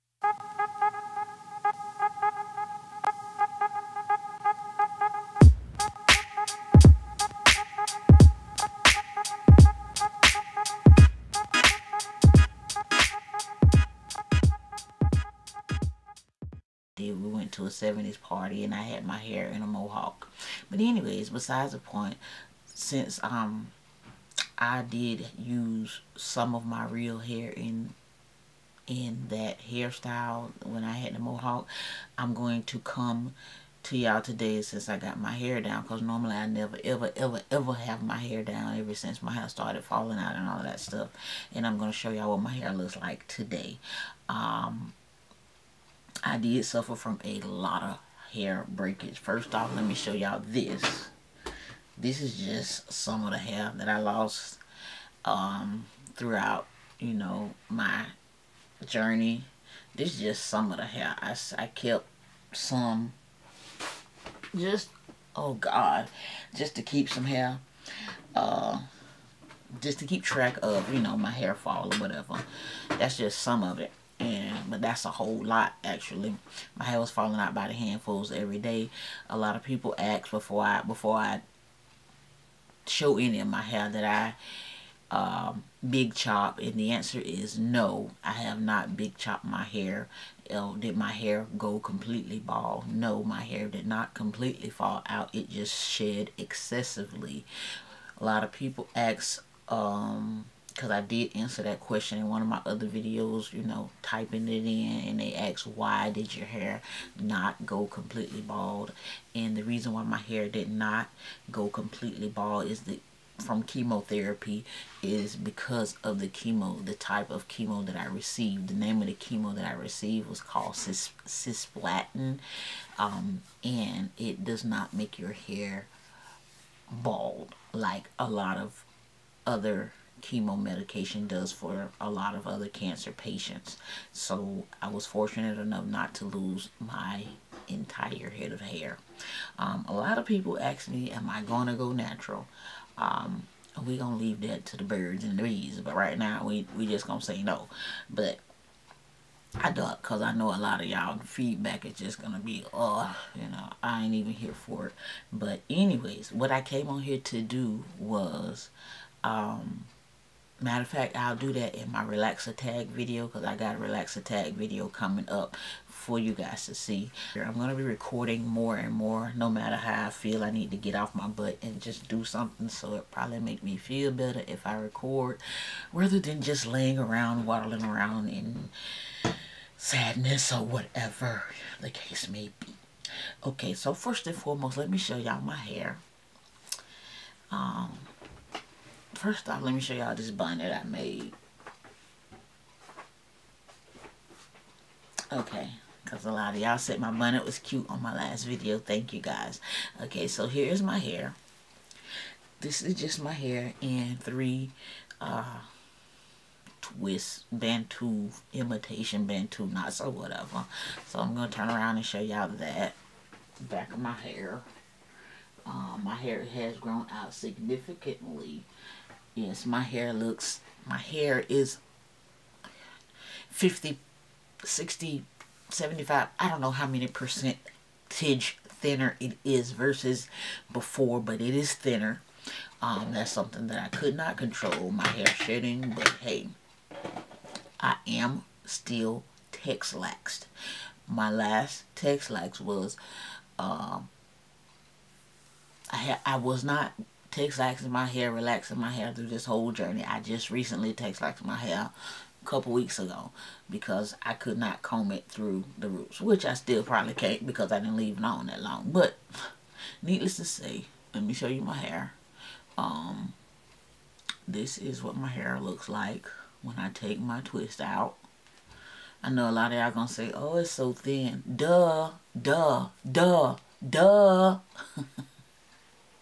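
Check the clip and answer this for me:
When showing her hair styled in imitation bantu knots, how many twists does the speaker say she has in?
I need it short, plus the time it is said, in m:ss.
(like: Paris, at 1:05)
3, at 3:24.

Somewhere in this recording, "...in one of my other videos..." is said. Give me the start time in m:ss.
1:42.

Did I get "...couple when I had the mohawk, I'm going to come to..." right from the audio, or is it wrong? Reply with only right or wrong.
wrong.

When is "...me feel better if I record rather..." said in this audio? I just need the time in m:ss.
2:53.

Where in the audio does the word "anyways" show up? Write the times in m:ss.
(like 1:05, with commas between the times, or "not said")
0:20, 2:35.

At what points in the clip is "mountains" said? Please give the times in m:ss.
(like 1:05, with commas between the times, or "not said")
not said.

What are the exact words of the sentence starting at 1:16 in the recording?
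My hair was falling out by the handfuls every day.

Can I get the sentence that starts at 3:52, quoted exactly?
Um, that's something that I could not control, my hair shedding, but hey, I am still texlaxed.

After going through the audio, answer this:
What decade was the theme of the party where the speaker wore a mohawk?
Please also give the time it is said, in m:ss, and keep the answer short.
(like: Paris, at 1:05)
70s, at 0:17.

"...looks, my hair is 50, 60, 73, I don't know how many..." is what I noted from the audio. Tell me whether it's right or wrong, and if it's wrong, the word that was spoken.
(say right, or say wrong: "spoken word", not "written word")
wrong: "75", not "73".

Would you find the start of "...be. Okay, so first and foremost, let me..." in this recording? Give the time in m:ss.
3:02.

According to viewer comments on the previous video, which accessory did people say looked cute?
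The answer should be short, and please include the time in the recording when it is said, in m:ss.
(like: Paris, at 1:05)
bonnet, at 3:17.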